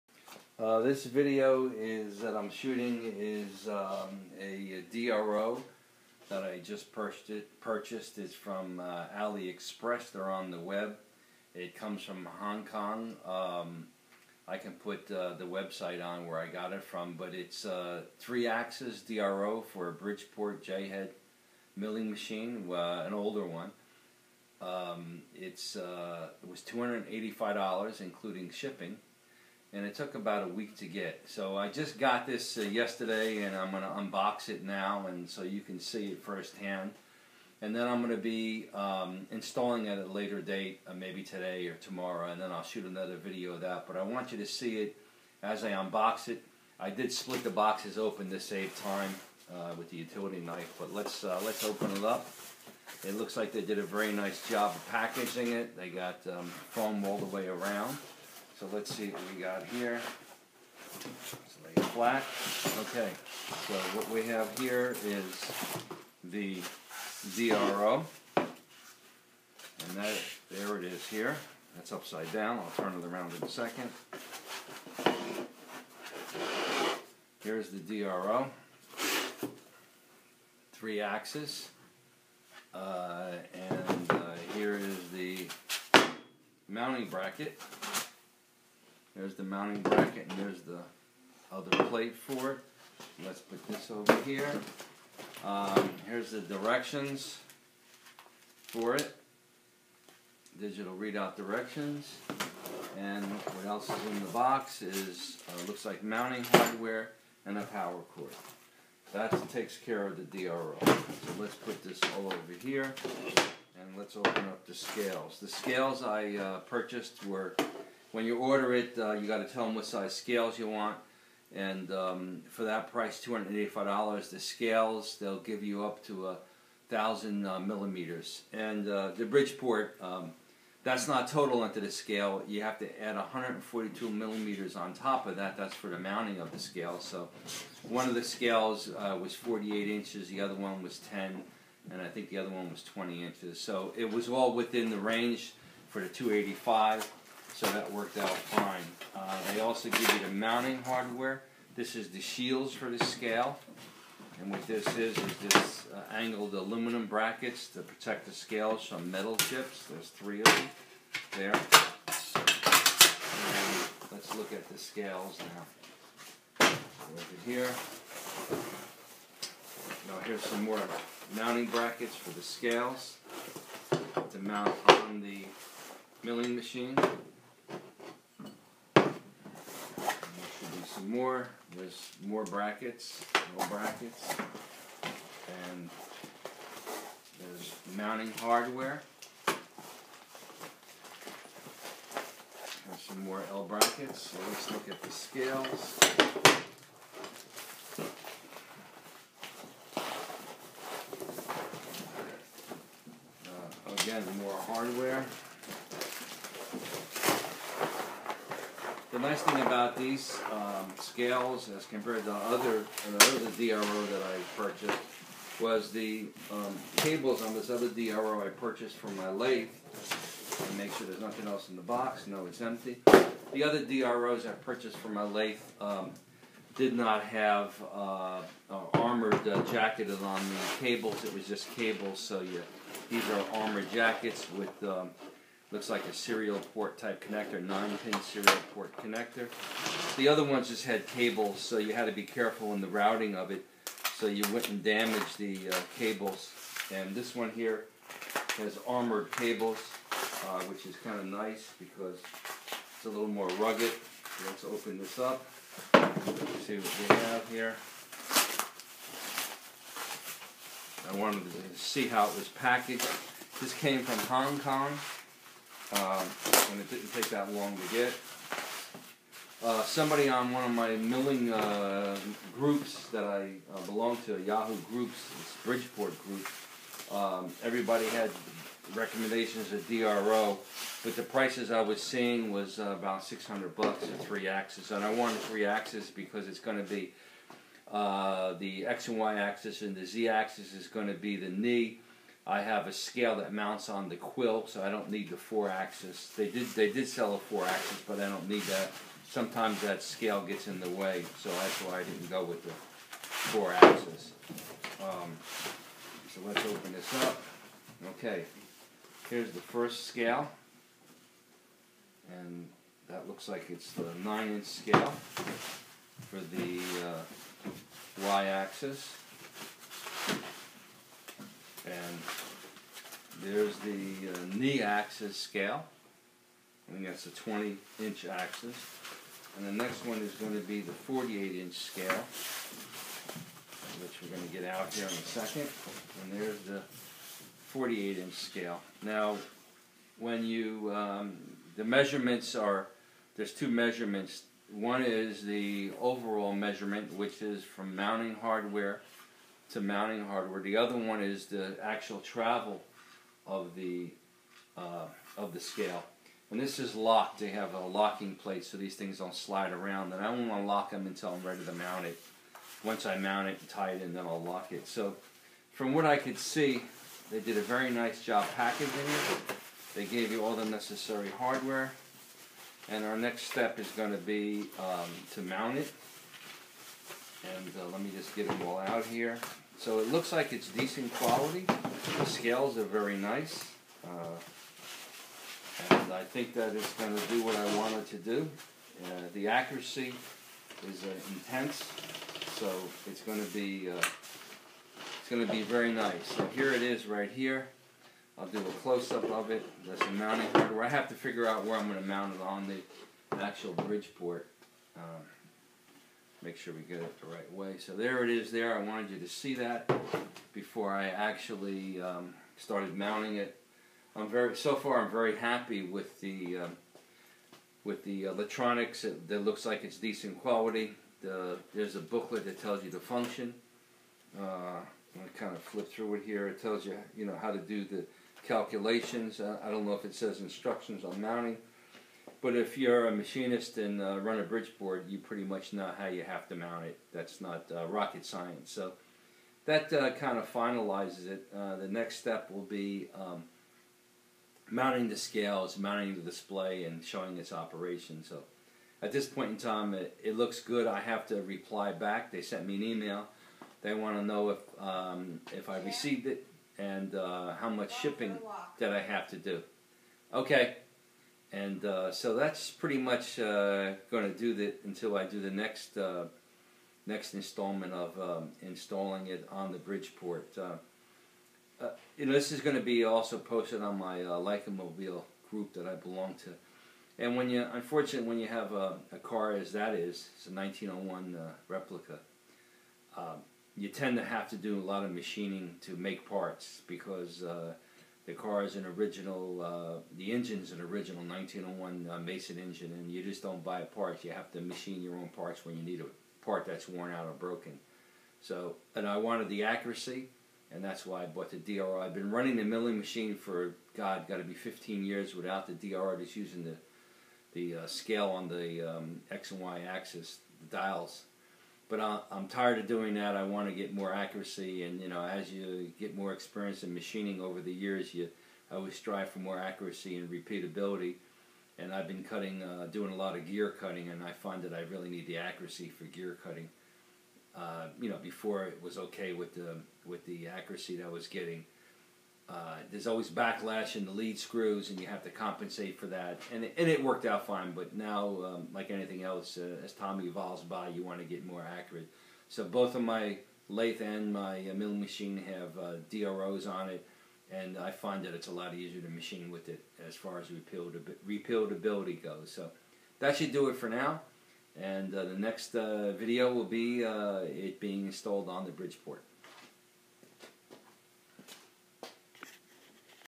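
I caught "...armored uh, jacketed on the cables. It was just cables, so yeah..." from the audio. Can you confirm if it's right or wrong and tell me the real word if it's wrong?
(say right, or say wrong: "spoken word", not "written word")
right.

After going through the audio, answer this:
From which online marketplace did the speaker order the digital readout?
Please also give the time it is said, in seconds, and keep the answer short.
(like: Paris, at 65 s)
AliExpress, at 9 s.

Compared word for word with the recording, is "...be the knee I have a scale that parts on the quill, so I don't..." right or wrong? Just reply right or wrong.
wrong.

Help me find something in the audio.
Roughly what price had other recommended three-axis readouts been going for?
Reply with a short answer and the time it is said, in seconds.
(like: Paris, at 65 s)
600 dollars, at 282 s.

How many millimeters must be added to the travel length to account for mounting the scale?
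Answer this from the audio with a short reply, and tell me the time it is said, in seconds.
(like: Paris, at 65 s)
142 millimeters, at 133 s.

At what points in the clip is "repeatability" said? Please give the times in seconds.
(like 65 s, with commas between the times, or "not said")
520 s, 550 s.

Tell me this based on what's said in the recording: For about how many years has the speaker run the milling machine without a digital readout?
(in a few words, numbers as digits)
15 years.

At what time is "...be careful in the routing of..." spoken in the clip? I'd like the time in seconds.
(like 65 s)
242 s.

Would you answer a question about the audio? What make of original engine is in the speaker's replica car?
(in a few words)
Mason.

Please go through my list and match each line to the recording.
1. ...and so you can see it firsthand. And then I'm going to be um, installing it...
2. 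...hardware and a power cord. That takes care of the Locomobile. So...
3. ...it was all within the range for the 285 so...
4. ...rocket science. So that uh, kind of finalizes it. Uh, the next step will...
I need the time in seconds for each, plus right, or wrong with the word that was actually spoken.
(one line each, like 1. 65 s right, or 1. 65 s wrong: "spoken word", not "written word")
1. 35 s right
2. 106 s wrong: "DRO", not "Locomobile"
3. 143 s right
4. 437 s right.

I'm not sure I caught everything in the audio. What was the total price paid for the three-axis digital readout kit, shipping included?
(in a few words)
$285.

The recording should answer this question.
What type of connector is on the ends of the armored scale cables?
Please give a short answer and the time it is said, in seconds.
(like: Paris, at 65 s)
9-pin serial port connector, at 237 s.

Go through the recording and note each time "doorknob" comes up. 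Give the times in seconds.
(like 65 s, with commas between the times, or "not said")
not said.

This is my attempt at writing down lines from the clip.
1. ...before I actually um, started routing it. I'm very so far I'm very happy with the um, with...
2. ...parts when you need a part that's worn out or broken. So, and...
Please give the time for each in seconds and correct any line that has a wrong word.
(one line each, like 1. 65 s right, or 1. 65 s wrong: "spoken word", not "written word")
1. 410 s wrong: "mounting", not "routing"
2. 495 s right.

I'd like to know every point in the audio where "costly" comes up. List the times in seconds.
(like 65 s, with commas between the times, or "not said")
not said.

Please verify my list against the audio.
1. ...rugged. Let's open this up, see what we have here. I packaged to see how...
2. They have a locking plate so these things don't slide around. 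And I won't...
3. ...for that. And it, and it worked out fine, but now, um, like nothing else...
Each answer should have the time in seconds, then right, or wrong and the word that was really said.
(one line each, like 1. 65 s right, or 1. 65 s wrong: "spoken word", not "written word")
1. 253 s wrong: "wanted", not "packaged"
2. 357 s right
3. 535 s wrong: "anything", not "nothing".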